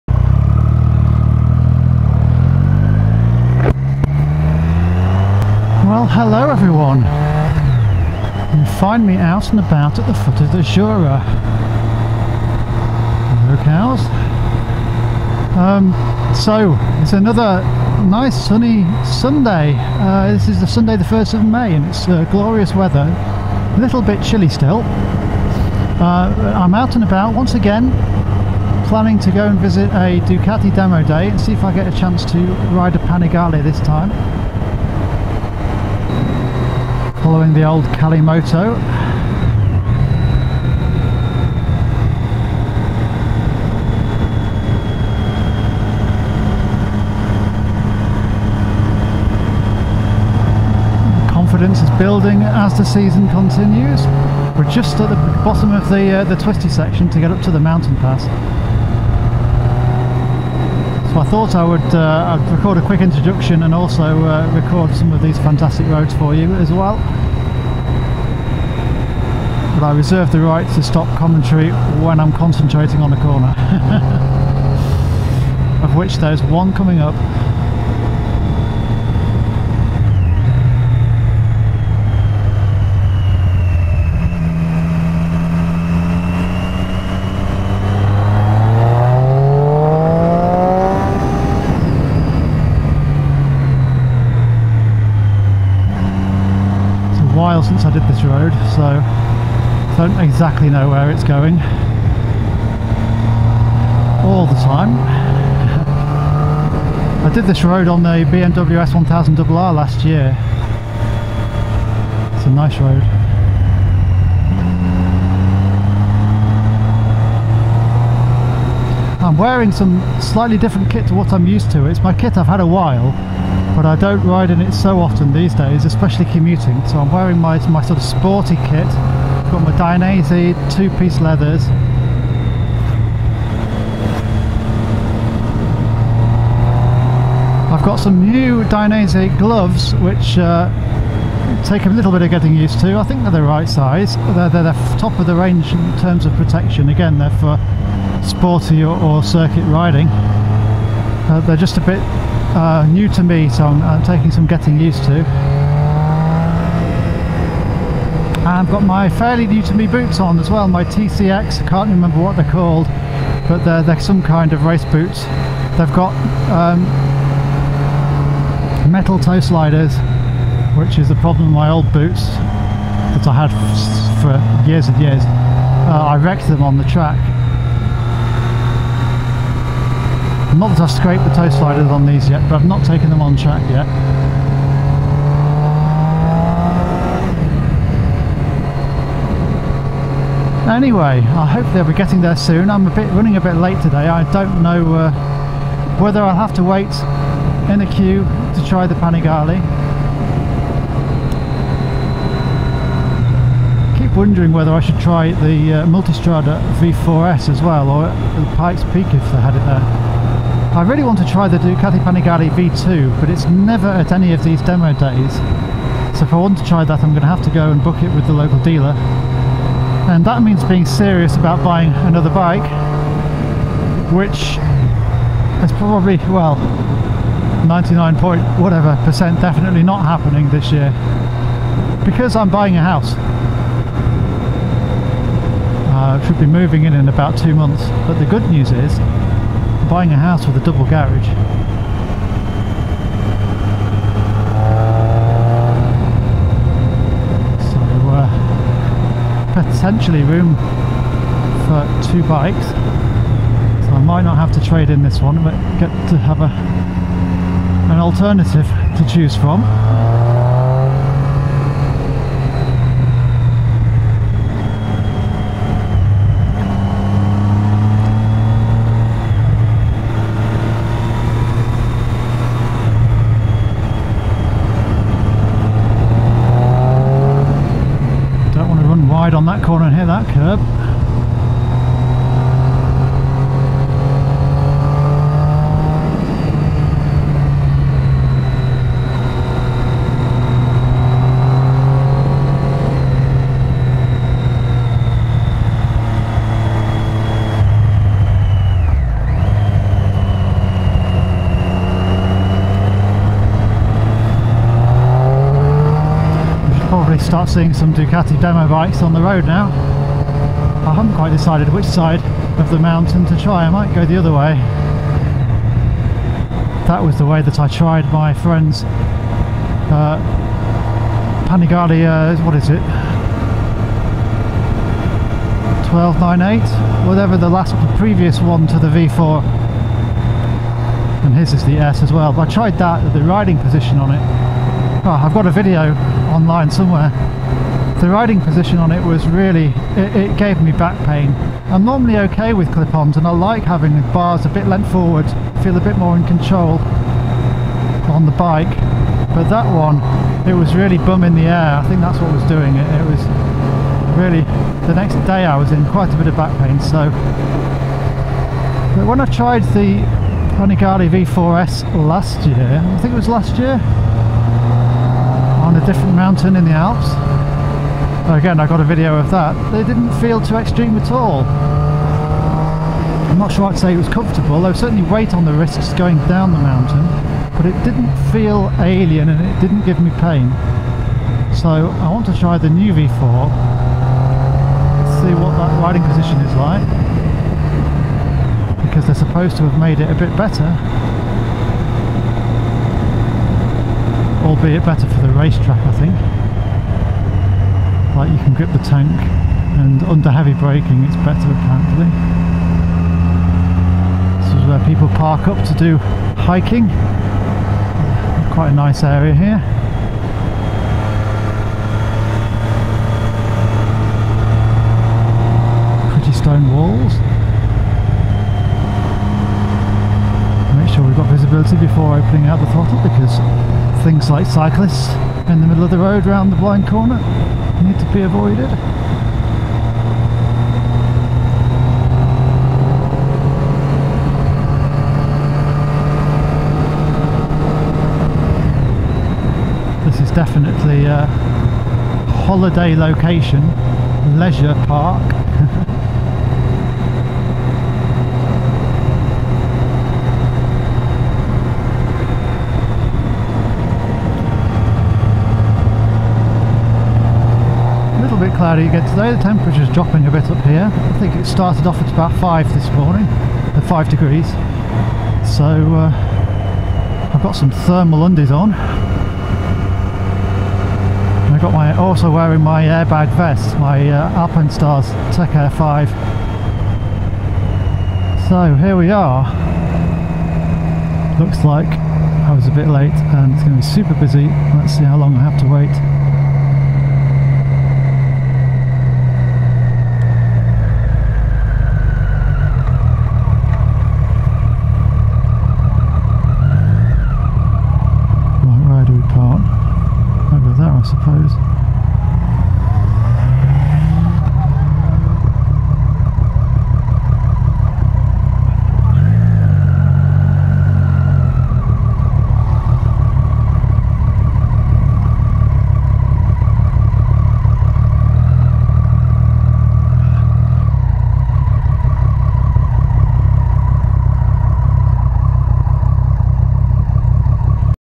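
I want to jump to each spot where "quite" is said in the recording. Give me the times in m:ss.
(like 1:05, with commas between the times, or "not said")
5:11, 5:55, 6:48.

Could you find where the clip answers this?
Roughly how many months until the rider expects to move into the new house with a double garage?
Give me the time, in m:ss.
3:57.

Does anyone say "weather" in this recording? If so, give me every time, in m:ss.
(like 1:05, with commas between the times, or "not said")
0:22.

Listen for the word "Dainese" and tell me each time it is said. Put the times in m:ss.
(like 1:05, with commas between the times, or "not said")
2:09, 2:18.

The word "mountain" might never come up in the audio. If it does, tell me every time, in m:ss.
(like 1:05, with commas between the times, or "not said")
0:57, 5:12, 6:06, 6:16.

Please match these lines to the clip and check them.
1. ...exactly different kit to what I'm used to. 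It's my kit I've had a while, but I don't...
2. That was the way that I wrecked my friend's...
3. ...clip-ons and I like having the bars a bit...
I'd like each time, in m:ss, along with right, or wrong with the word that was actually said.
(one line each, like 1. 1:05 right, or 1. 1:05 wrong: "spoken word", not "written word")
1. 2:00 wrong: "slightly", not "exactly"
2. 5:16 wrong: "tried", not "wrecked"
3. 5:42 right.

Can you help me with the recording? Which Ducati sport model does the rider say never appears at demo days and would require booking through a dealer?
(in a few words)
Panigale V2.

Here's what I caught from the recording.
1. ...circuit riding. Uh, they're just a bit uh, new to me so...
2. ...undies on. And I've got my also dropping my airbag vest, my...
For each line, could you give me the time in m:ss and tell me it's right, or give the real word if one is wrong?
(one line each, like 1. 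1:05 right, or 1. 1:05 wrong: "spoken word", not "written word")
1. 2:29 right
2. 7:48 wrong: "wearing", not "dropping".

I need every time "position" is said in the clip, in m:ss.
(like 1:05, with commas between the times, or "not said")
5:33, 5:38, 6:26.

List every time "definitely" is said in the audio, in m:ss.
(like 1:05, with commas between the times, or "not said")
3:49, 7:20.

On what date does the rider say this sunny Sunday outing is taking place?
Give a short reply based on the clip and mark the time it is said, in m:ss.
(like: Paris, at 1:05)
1st of May, at 0:20.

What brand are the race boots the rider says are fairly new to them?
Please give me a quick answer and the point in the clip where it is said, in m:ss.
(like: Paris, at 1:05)
TCX, at 2:40.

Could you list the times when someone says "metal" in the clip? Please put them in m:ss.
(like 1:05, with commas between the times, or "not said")
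2:48.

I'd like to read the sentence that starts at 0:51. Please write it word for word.
Confidence is building as the season continues.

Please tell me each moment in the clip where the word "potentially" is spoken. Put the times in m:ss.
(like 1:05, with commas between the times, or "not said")
4:09.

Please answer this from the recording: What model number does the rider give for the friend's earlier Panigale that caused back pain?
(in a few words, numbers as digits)
1298.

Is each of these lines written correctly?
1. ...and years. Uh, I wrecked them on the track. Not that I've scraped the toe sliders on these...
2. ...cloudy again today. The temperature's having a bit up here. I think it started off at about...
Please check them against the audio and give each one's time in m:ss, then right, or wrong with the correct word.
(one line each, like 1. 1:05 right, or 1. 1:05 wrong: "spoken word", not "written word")
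1. 2:54 right
2. 7:38 wrong: "dropping", not "having".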